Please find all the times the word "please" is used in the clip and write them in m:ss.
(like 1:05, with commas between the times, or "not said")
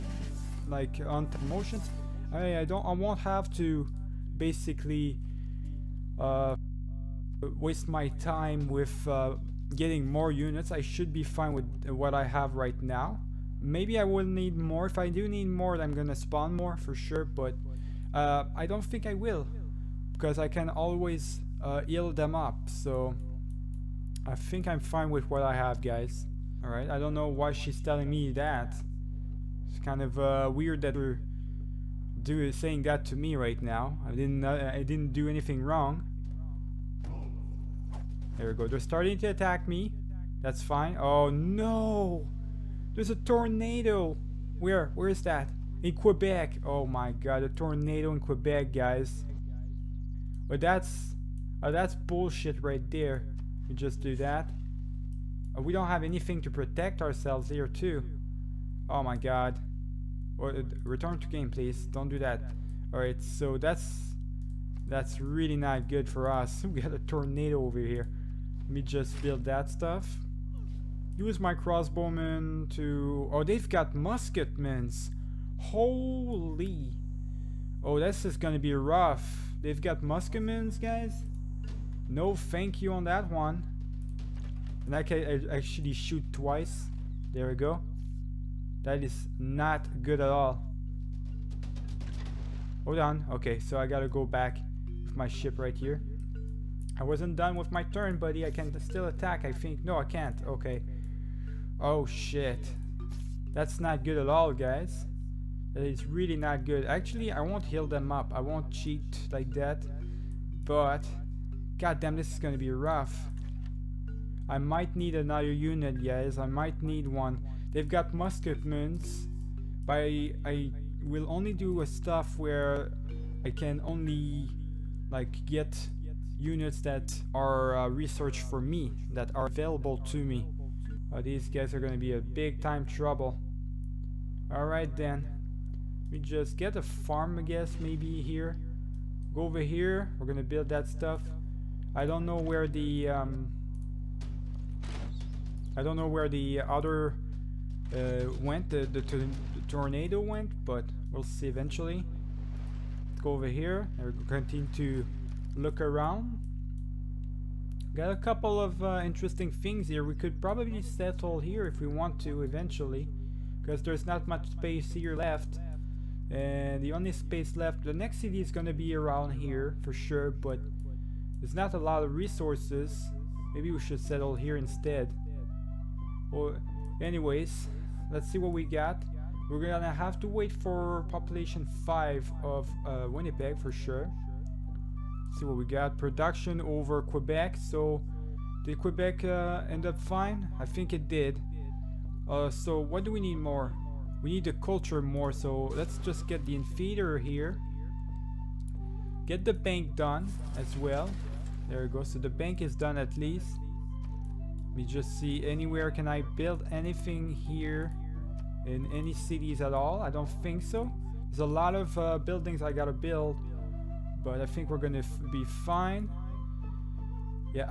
1:01.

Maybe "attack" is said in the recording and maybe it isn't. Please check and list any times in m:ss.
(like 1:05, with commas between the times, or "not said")
0:39, 1:39.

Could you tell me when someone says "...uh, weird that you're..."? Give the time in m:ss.
0:30.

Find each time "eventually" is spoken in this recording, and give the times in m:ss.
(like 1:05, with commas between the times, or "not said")
2:31, 2:42.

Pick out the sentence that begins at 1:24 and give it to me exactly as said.
And I can actually shoot twice.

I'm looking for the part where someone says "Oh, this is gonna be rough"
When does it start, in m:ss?
1:17.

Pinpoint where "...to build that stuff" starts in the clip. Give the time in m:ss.
2:20.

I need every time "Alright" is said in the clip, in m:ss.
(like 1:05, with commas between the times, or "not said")
1:02, 2:14.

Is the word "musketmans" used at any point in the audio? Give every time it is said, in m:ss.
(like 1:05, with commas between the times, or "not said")
1:13, 1:20, 1:58.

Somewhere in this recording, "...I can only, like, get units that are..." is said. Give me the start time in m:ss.
2:03.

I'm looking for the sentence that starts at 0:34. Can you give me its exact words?
I didn't uh, I didn't do anything wrong.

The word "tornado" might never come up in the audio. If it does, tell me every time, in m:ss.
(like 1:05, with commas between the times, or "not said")
0:43, 0:47, 1:06, 2:29.